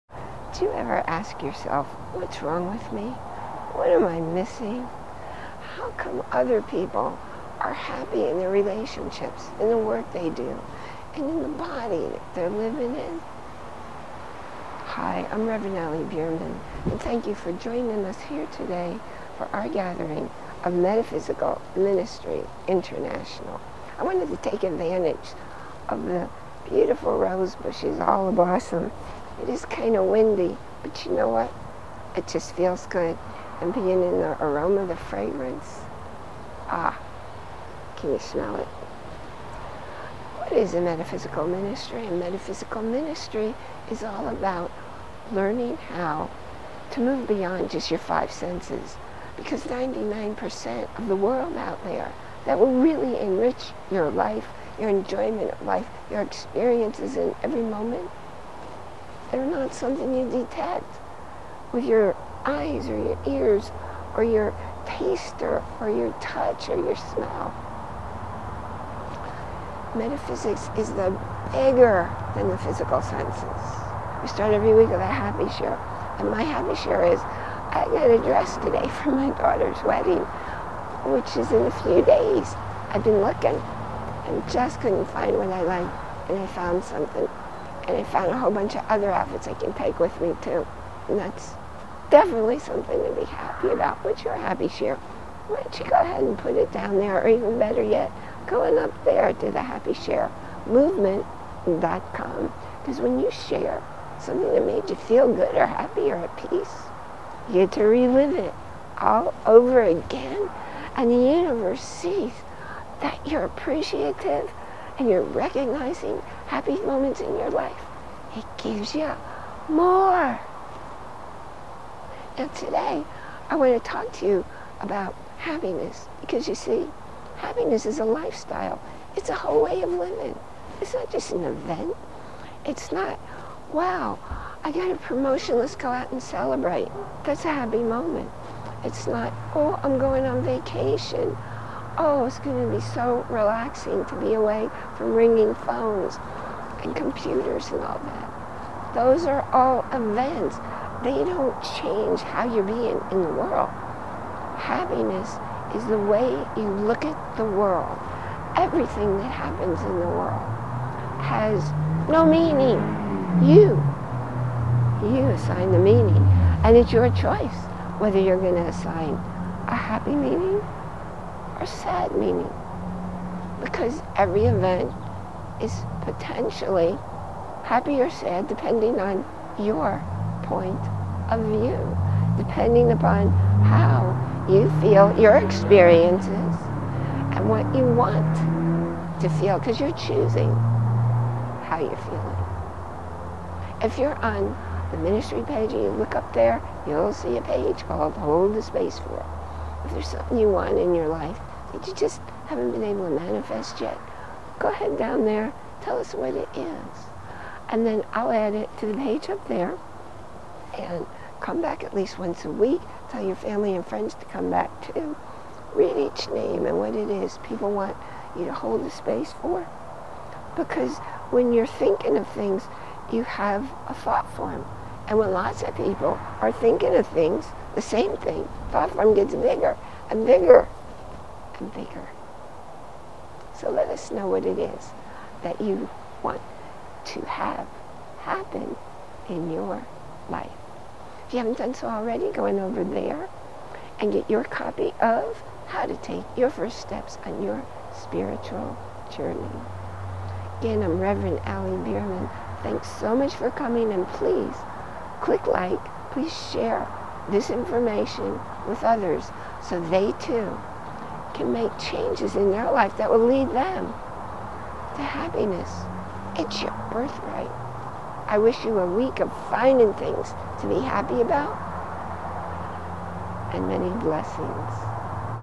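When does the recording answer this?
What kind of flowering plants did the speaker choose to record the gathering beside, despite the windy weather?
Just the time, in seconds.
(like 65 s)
27 s.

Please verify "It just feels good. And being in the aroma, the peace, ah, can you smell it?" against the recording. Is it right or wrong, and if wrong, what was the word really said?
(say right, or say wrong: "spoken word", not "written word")
wrong: "fragrance", not "peace".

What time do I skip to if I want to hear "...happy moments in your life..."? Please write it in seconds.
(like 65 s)
116 s.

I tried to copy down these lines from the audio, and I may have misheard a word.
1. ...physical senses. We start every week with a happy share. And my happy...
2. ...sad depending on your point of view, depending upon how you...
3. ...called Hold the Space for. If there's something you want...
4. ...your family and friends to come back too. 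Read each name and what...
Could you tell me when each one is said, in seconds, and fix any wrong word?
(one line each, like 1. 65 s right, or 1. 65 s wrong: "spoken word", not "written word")
1. 72 s right
2. 178 s right
3. 197 s right
4. 213 s right.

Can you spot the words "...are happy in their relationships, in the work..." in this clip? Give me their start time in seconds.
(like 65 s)
7 s.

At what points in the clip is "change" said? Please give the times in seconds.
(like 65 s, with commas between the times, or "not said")
151 s, 261 s.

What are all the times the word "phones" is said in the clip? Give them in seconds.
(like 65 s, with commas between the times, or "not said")
145 s.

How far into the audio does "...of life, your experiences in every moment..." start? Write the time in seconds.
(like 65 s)
55 s.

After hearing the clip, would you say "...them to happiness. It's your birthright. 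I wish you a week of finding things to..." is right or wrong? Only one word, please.
right.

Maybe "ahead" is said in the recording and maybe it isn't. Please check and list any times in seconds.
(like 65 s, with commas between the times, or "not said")
95 s, 204 s.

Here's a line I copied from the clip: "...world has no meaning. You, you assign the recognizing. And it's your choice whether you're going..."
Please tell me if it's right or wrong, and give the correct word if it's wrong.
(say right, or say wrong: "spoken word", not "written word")
wrong: "meaning", not "recognizing".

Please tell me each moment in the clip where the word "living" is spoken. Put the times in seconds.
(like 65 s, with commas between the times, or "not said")
12 s, 129 s.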